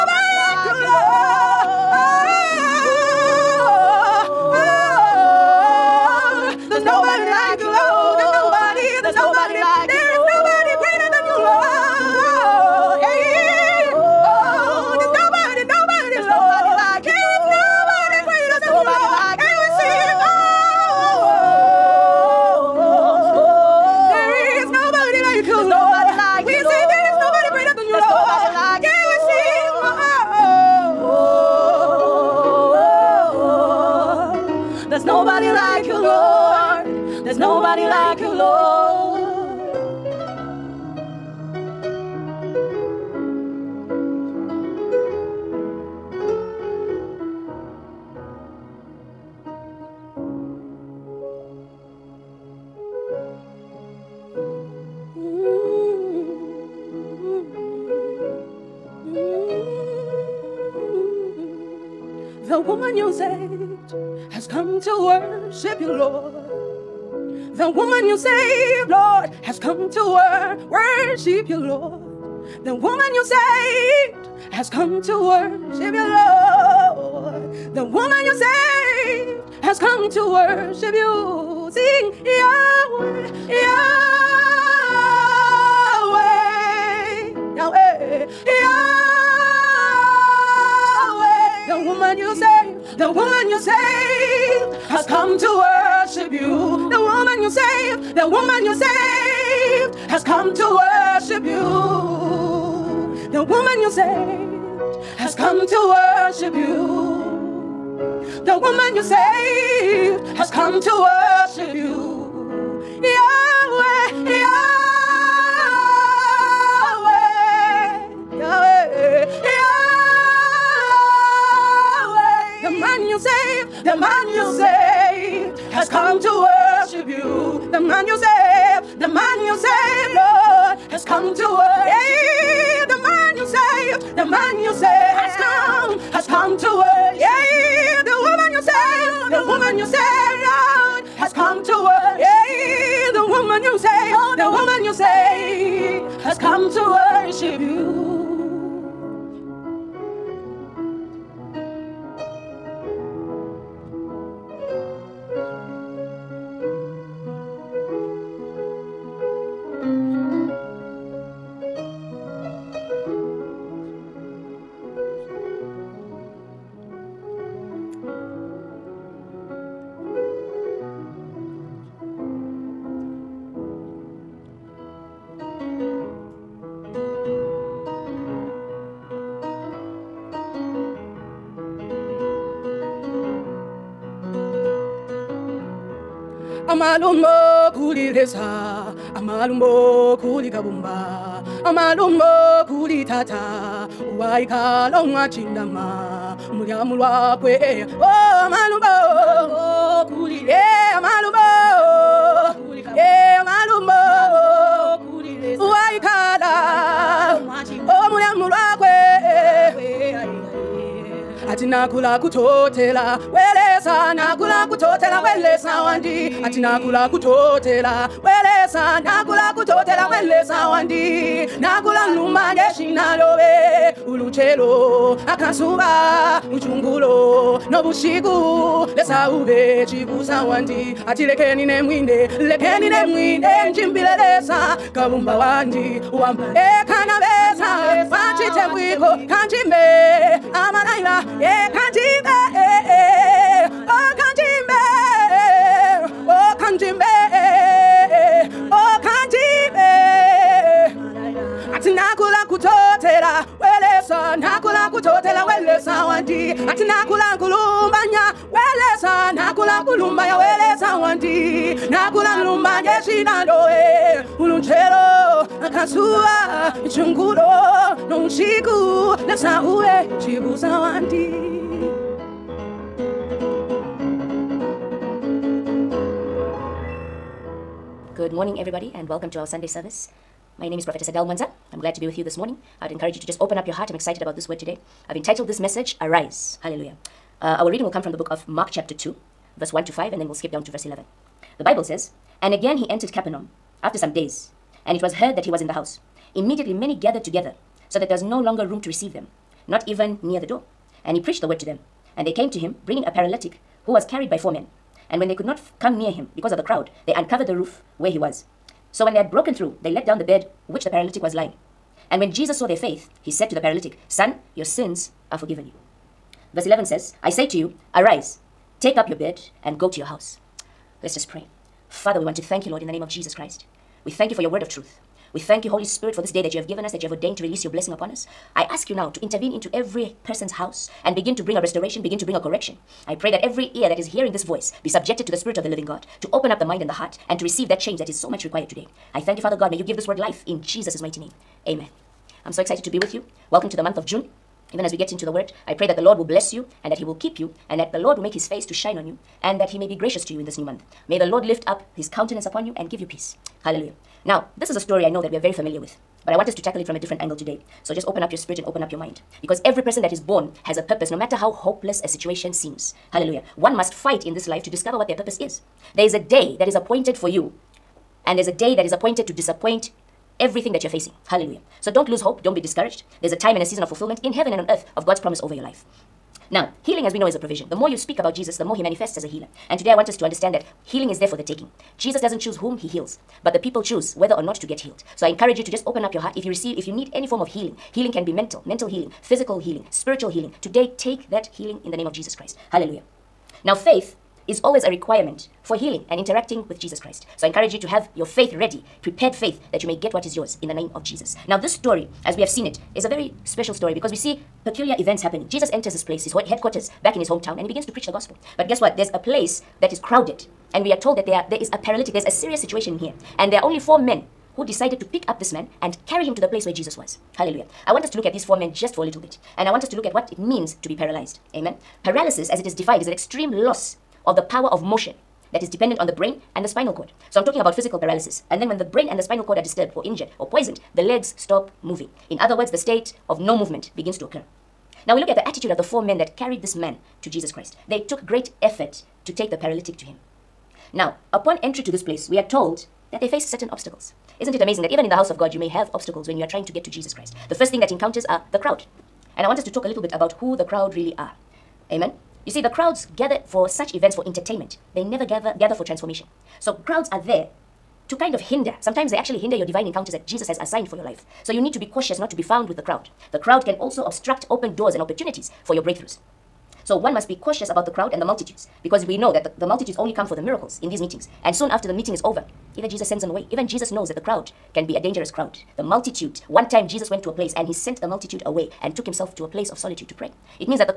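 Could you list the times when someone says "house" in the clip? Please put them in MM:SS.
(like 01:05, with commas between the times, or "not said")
04:55, 05:20, 05:30, 07:25.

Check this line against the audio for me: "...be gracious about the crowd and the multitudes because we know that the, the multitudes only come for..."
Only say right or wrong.
wrong.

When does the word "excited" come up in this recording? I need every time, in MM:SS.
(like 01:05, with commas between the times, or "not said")
04:43, 05:42.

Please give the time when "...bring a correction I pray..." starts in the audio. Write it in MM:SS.
05:32.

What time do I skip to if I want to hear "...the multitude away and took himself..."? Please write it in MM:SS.
07:58.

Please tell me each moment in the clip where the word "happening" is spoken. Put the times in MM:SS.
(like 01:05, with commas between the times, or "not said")
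06:45.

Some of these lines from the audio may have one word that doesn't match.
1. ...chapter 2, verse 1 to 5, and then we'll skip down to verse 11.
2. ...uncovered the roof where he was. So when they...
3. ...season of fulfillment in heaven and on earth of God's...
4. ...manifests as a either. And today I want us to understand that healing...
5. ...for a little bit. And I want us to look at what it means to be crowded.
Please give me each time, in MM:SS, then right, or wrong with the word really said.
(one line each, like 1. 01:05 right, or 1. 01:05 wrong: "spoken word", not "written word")
1. 04:48 right
2. 05:07 right
3. 06:13 right
4. 06:18 wrong: "healer", not "either"
5. 06:58 wrong: "paralyzed", not "crowded".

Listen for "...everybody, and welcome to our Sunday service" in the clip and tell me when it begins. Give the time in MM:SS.
04:38.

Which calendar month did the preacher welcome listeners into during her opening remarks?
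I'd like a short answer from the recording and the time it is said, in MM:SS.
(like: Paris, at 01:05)
June, at 05:44.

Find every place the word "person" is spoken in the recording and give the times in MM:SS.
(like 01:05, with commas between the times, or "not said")
05:30, 05:59.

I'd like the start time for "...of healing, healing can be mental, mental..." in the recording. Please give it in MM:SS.
06:27.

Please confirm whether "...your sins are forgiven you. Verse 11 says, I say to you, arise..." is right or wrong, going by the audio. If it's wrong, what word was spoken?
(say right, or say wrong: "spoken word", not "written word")
right.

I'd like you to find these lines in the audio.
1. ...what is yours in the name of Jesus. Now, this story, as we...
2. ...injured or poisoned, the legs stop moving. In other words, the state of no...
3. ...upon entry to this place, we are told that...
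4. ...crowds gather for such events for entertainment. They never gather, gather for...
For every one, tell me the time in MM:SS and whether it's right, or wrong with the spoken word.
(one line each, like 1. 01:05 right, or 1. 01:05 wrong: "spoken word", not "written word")
1. 06:40 right
2. 07:10 right
3. 07:21 right
4. 07:32 right.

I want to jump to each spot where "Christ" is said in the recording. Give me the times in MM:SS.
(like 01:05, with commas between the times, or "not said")
05:23, 06:32, 06:36, 07:17, 07:27.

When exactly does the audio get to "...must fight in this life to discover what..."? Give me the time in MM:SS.
06:03.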